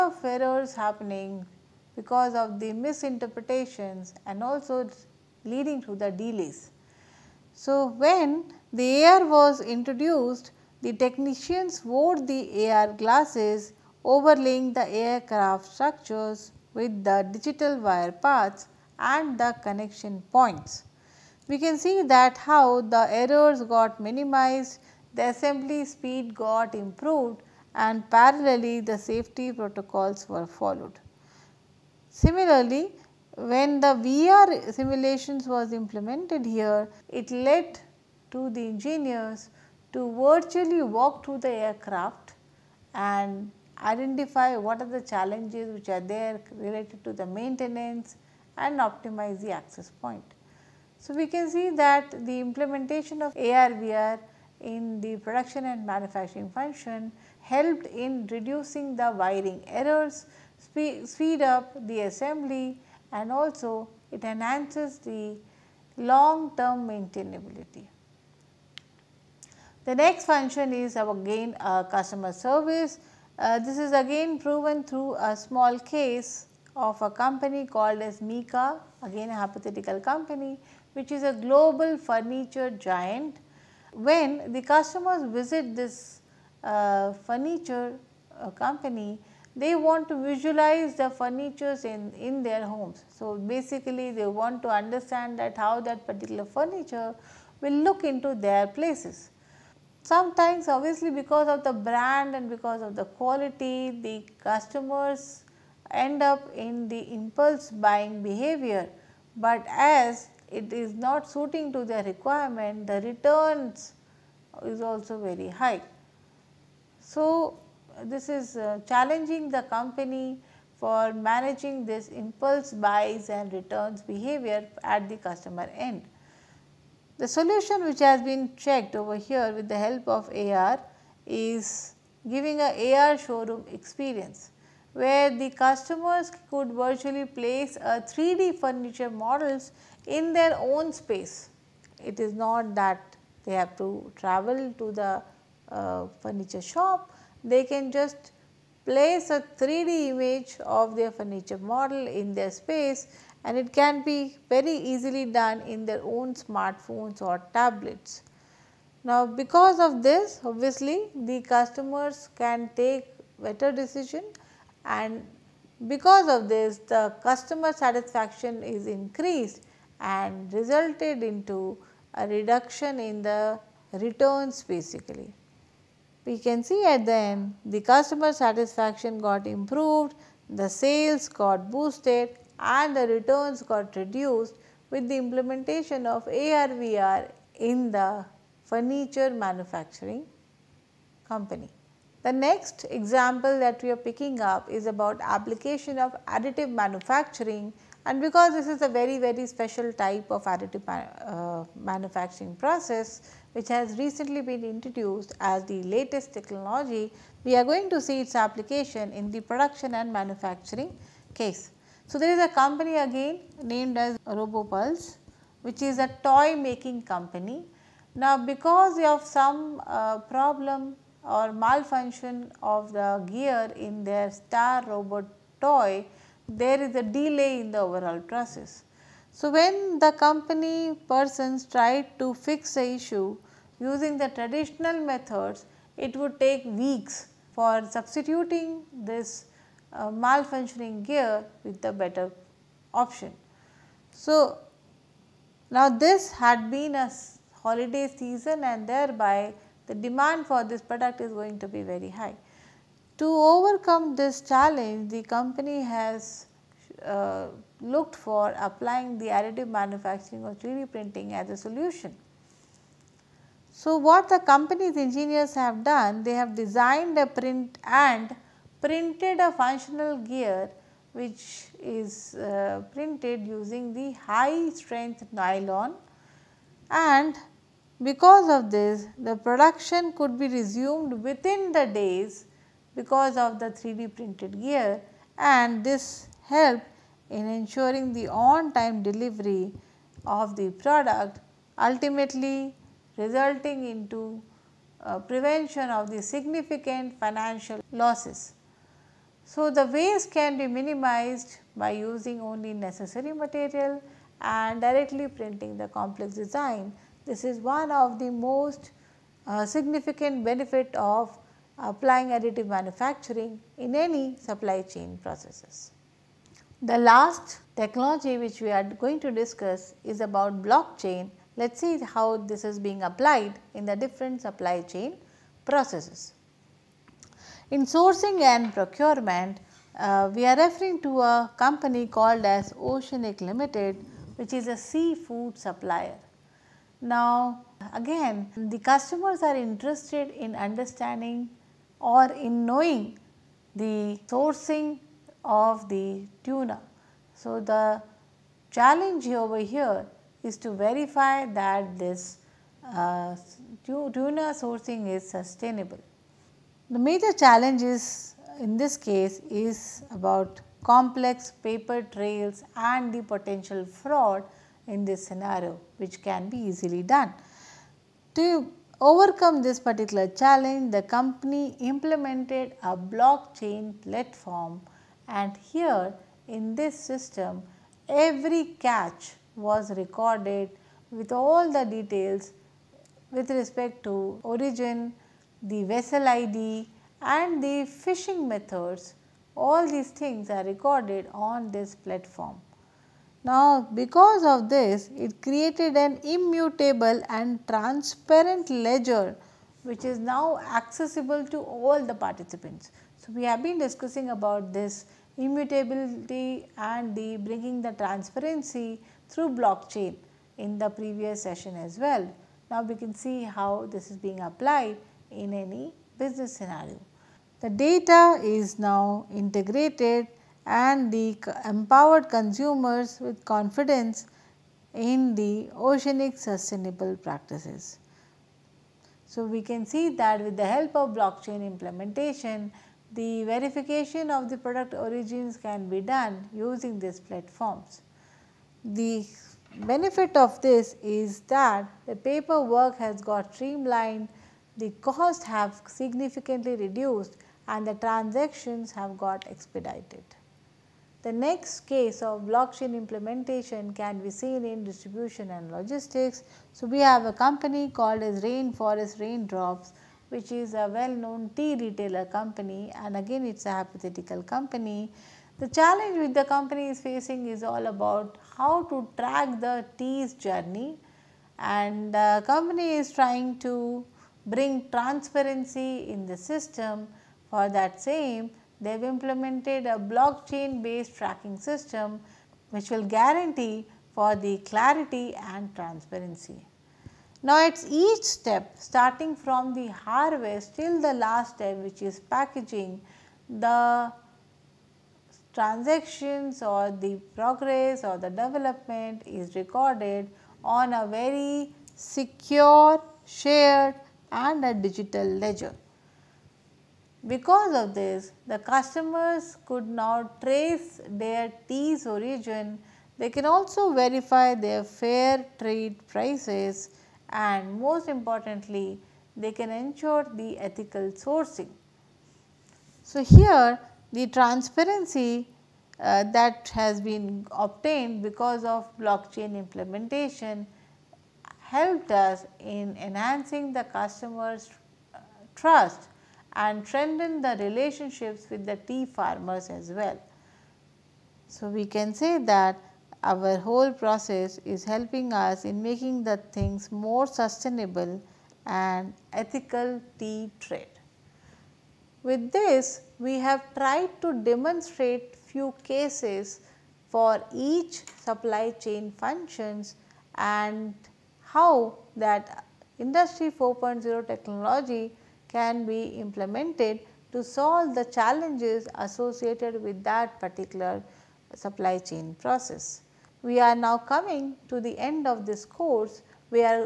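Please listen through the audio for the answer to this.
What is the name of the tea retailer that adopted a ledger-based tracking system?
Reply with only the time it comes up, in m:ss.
7:38.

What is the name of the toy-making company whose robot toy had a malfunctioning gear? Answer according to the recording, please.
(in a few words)
RoboPulse.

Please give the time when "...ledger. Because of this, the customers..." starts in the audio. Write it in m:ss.
8:25.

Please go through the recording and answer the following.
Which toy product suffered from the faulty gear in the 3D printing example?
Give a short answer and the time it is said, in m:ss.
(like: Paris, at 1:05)
Star robot toy, at 3:44.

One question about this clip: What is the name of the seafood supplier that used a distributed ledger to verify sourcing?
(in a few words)
Oceanic Limited.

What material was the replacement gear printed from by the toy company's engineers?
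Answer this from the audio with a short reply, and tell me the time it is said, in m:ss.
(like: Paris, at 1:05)
High strength nylon, at 4:34.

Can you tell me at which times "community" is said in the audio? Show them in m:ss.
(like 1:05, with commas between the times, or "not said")
not said.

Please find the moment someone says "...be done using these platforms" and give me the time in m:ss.
7:15.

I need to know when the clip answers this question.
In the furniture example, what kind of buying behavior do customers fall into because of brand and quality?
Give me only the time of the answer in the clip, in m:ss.
1:47.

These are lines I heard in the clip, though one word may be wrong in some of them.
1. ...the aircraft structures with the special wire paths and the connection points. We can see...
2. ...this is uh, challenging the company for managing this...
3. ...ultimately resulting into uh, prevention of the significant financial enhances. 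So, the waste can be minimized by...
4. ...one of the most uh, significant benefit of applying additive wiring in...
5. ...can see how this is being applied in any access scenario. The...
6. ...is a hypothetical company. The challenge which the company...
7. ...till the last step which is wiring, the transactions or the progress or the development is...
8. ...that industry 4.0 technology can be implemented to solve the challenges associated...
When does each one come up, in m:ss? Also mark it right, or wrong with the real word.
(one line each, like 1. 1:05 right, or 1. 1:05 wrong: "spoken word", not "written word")
1. 0:14 wrong: "digital", not "special"
2. 1:58 right
3. 4:51 wrong: "losses", not "enhances"
4. 5:07 wrong: "manufacturing", not "wiring"
5. 6:52 wrong: "business", not "access"
6. 7:43 right
7. 8:10 wrong: "packaging", not "wiring"
8. 9:22 right.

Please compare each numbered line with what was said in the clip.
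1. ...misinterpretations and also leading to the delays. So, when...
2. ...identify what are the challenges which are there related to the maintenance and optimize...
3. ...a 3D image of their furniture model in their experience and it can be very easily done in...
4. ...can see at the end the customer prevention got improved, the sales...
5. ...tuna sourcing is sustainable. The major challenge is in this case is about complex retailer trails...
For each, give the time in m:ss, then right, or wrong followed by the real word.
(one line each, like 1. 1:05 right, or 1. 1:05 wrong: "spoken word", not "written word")
1. 0:02 right
2. 0:43 right
3. 2:29 wrong: "space", not "experience"
4. 2:56 wrong: "satisfaction", not "prevention"
5. 5:53 wrong: "paper", not "retailer".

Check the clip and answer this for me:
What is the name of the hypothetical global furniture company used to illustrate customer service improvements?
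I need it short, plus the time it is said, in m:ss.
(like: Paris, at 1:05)
Mika, at 1:18.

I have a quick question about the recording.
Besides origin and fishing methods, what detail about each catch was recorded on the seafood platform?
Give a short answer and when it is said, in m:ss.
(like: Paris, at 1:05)
Vessel ID, at 6:25.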